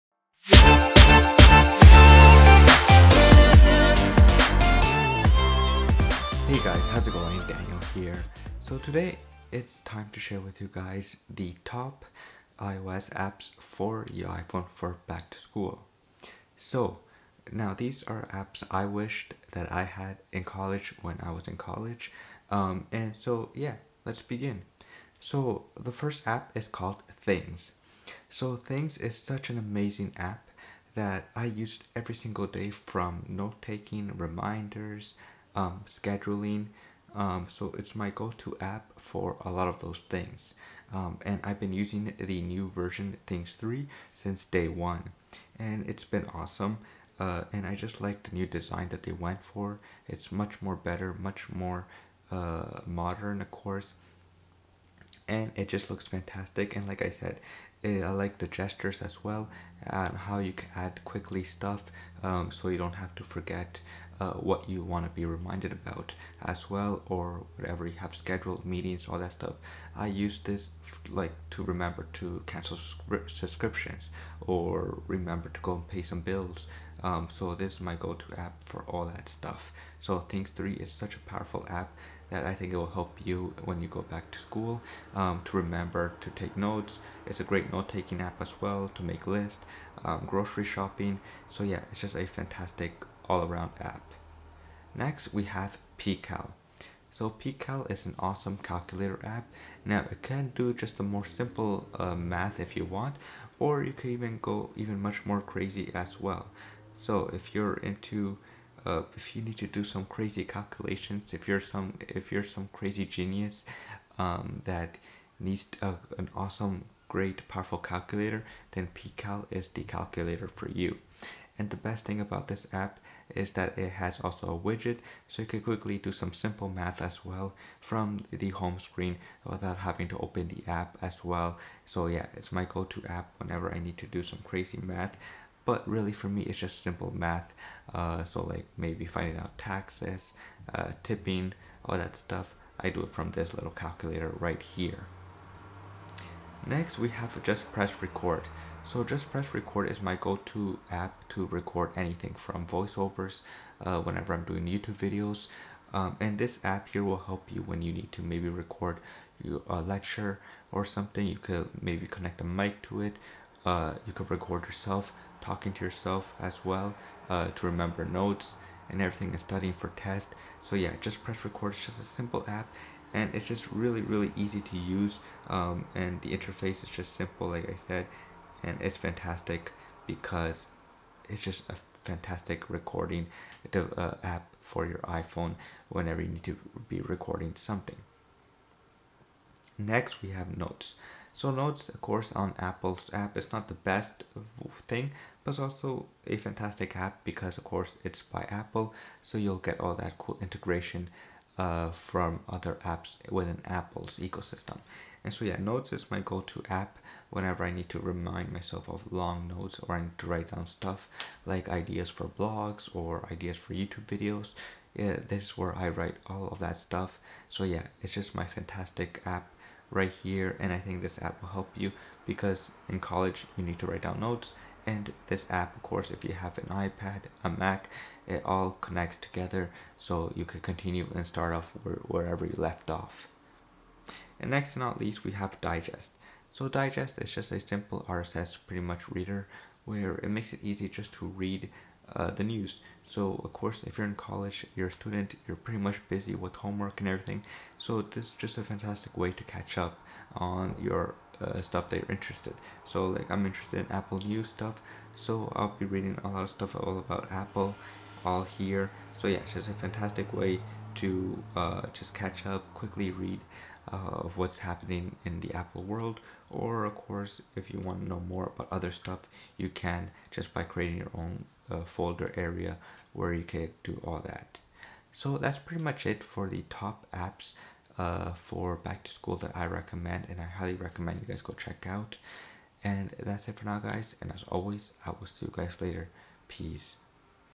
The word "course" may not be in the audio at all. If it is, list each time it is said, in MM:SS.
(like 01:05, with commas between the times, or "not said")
00:53, 03:12, 03:17, 03:45, 04:03, 04:26.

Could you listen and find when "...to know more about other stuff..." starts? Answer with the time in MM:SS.
04:28.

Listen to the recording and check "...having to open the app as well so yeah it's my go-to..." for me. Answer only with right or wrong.
right.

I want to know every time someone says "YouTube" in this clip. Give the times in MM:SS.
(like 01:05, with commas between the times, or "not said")
02:34, 03:33.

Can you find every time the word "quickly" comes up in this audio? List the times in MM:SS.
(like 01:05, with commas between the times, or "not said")
01:01, 02:05, 04:22.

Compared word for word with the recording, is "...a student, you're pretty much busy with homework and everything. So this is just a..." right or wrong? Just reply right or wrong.
right.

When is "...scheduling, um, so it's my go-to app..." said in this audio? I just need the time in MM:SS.
00:35.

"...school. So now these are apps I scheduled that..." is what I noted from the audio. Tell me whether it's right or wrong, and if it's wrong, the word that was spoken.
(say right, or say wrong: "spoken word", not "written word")
wrong: "wished", not "scheduled".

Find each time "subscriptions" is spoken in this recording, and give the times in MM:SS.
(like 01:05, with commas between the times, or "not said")
01:13.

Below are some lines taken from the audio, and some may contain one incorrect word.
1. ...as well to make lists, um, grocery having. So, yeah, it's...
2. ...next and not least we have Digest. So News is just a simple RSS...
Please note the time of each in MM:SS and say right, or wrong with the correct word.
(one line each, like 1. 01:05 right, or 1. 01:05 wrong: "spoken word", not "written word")
1. 01:28 wrong: "shopping", not "having"
2. 03:54 wrong: "Digest", not "News".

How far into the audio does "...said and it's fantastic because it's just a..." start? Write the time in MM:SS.
02:57.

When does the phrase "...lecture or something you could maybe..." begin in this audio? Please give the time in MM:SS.
02:39.